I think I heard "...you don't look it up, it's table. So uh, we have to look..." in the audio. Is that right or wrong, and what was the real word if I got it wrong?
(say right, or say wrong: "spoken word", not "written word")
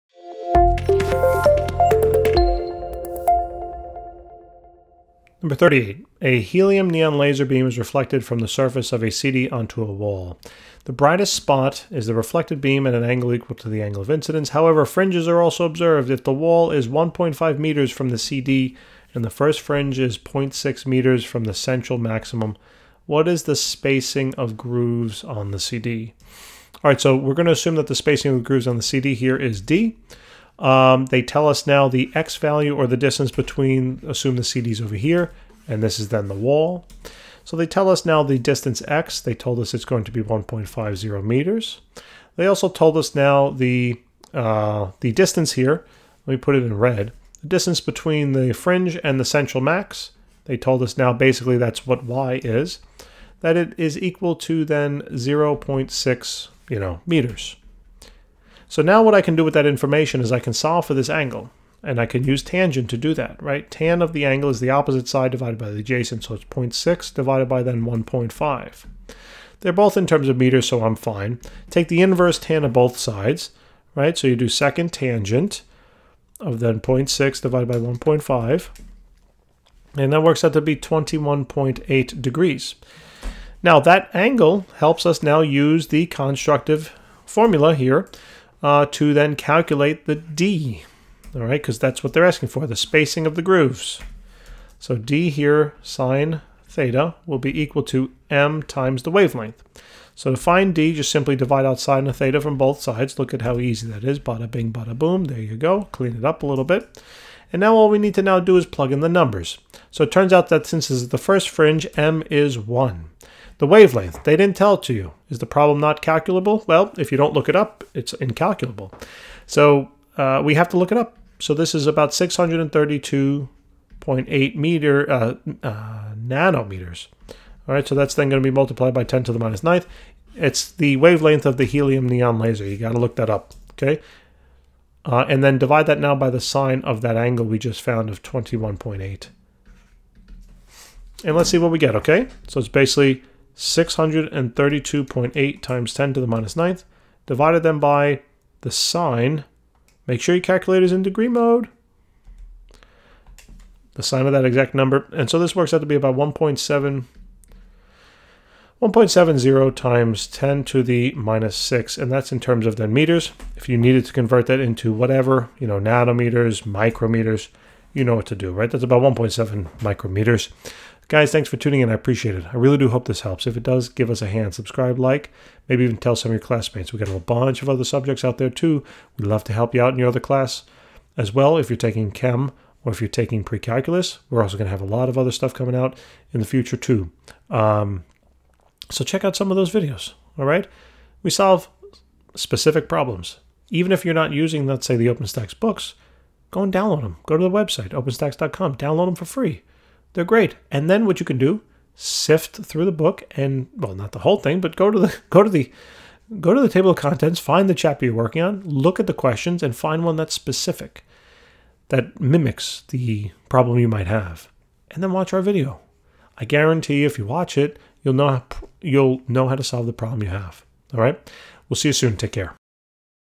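wrong: "incalculable", not "table".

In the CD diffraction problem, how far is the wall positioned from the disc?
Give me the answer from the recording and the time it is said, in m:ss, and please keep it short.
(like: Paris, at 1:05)
1.5 meters, at 0:40.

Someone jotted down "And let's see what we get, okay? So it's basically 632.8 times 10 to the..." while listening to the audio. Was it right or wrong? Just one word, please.
right.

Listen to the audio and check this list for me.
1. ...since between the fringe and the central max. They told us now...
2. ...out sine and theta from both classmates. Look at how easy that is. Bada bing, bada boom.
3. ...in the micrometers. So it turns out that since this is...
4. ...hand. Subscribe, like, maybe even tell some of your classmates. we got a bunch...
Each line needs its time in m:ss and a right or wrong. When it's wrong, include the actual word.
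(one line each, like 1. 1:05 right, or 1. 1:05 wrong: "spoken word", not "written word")
1. 0:47 wrong: "distance", not "since"
2. 1:41 wrong: "sides", not "classmates"
3. 1:48 wrong: "numbers", not "micrometers"
4. 2:54 right.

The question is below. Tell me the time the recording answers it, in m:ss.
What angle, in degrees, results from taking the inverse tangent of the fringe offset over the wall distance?
1:20.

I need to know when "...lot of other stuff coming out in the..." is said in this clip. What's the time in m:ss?
3:04.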